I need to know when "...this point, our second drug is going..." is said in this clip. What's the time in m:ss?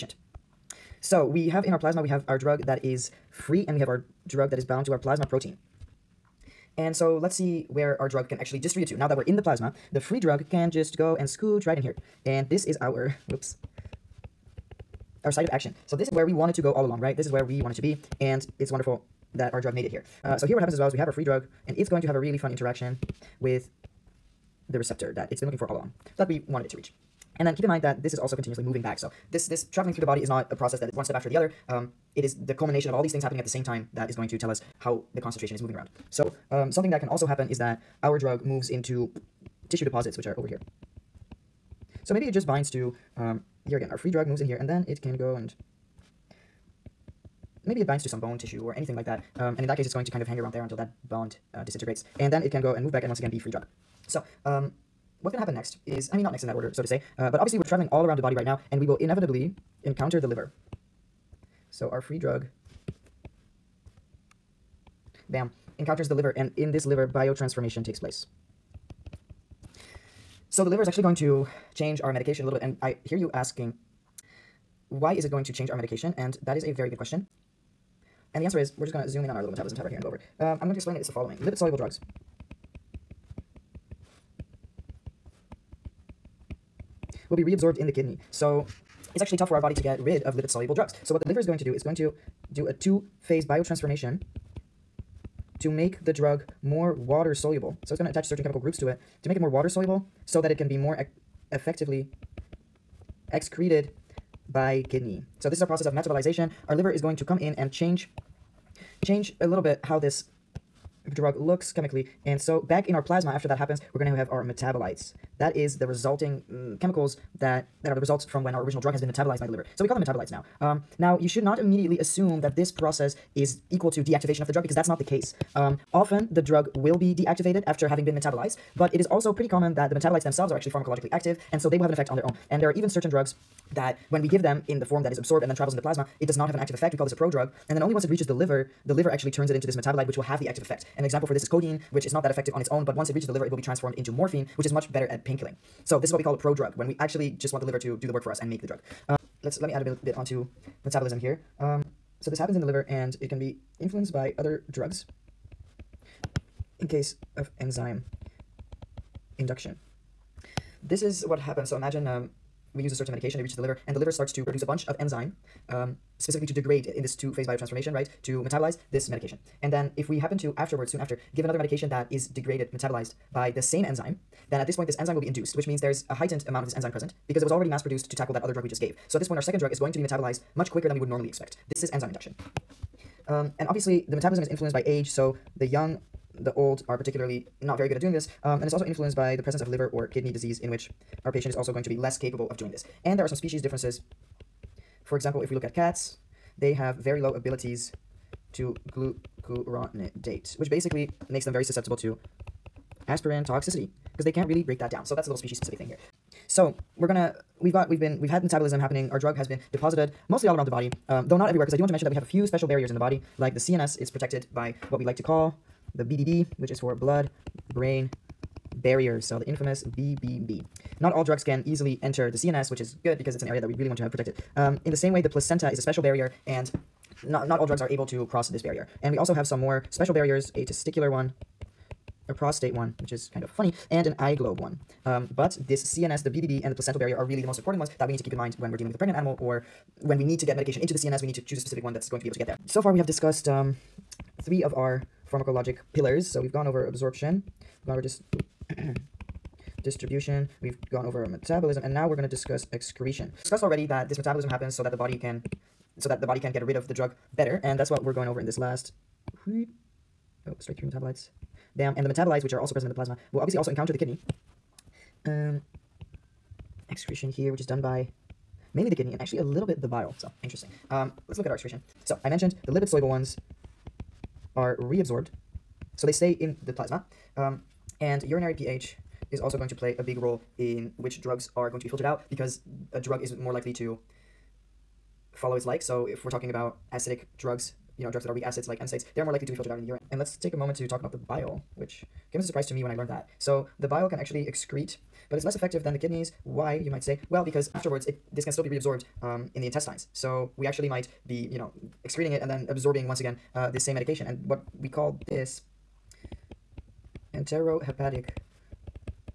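2:59.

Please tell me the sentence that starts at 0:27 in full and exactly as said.
And then keep in mind that this is also continuously moving back.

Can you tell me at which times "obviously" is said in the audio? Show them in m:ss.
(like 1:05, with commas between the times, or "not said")
0:57, 3:03, 4:23.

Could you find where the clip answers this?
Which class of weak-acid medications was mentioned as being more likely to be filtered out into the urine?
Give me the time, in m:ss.
4:48.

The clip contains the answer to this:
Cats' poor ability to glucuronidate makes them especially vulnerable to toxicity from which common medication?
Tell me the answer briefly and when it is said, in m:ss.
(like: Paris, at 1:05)
Aspirin, at 3:23.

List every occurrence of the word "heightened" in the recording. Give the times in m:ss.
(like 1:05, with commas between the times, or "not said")
2:56.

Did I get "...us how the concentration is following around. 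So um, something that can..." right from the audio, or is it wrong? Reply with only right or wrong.
wrong.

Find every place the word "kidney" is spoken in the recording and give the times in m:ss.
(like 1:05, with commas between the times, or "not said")
1:27, 1:44, 3:10, 4:23, 4:28, 4:55.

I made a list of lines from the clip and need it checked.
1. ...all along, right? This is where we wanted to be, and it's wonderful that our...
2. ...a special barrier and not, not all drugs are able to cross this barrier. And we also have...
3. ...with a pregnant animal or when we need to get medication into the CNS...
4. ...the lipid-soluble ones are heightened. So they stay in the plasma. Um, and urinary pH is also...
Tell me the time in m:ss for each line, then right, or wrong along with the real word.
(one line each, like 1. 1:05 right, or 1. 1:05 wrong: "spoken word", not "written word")
1. 0:16 right
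2. 3:45 right
3. 3:58 right
4. 4:32 wrong: "reabsorbed", not "heightened".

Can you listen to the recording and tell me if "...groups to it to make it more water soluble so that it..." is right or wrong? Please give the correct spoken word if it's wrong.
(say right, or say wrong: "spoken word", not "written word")
right.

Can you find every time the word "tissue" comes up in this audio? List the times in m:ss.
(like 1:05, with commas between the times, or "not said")
0:39, 0:48.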